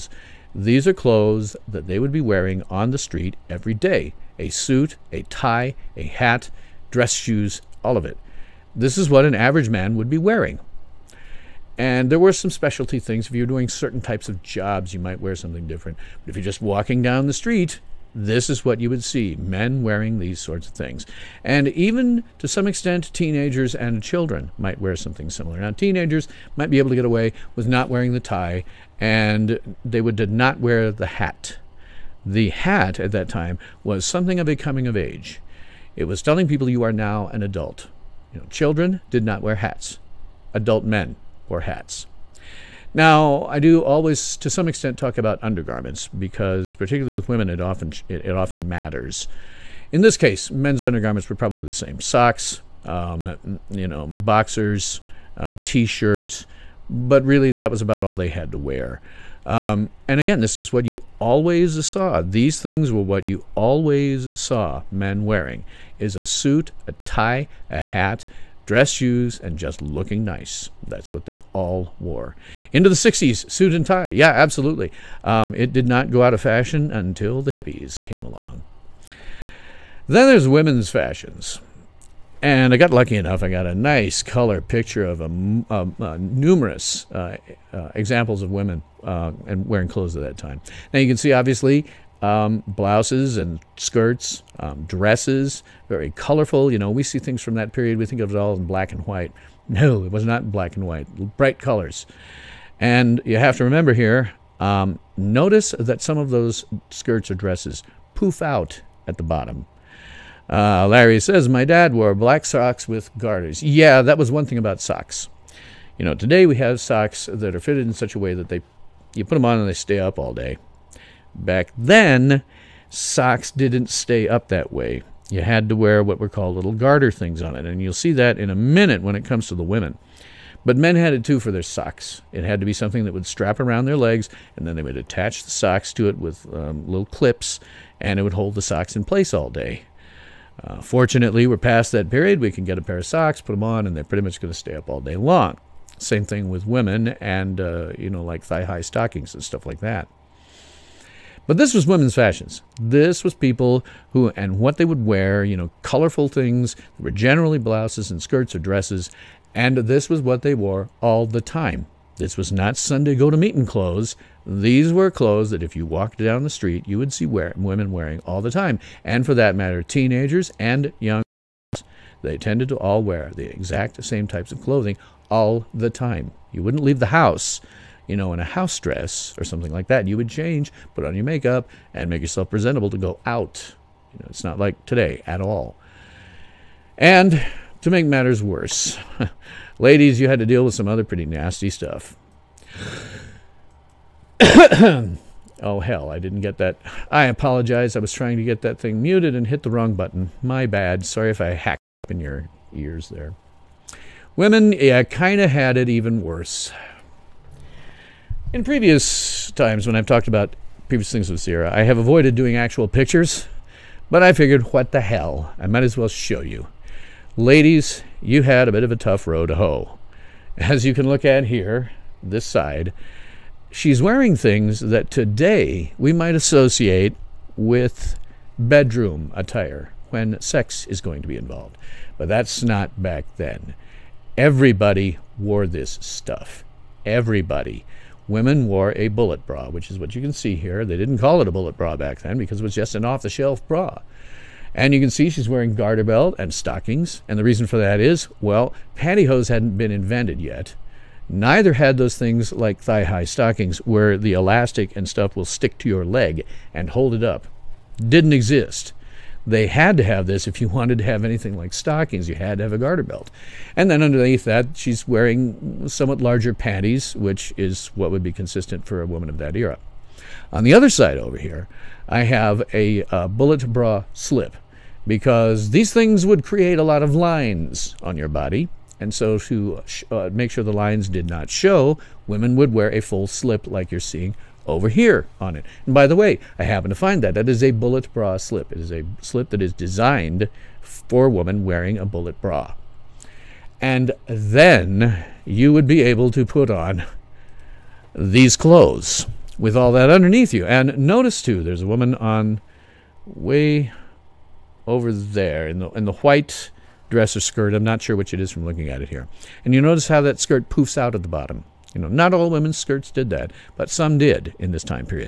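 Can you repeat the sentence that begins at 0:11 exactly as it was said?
And there were some specialty things.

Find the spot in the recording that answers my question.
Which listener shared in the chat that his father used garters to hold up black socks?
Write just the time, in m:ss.
1:50.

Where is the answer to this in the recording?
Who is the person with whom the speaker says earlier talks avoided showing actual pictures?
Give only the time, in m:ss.
3:31.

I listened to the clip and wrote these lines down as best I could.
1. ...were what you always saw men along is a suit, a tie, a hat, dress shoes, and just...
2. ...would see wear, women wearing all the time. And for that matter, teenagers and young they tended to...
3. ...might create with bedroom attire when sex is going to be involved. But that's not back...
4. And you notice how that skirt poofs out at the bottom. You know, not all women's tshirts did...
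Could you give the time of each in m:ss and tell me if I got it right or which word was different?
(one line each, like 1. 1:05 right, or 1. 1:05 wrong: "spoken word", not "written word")
1. 1:02 wrong: "wearing", not "along"
2. 2:46 right
3. 3:46 wrong: "associate", not "create"
4. 5:09 wrong: "skirts", not "tshirts".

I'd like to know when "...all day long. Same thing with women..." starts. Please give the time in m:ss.
2:24.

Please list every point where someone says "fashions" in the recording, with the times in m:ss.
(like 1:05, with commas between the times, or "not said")
1:16, 1:20, 2:32.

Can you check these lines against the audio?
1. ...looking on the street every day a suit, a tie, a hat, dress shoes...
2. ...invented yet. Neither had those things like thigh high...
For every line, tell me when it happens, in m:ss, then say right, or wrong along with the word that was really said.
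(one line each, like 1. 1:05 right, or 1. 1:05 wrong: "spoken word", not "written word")
1. 0:02 wrong: "wearing", not "looking"
2. 4:09 right.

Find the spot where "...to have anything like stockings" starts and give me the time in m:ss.
4:20.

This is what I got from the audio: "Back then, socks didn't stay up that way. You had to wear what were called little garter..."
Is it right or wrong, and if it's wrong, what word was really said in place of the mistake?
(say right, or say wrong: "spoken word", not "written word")
right.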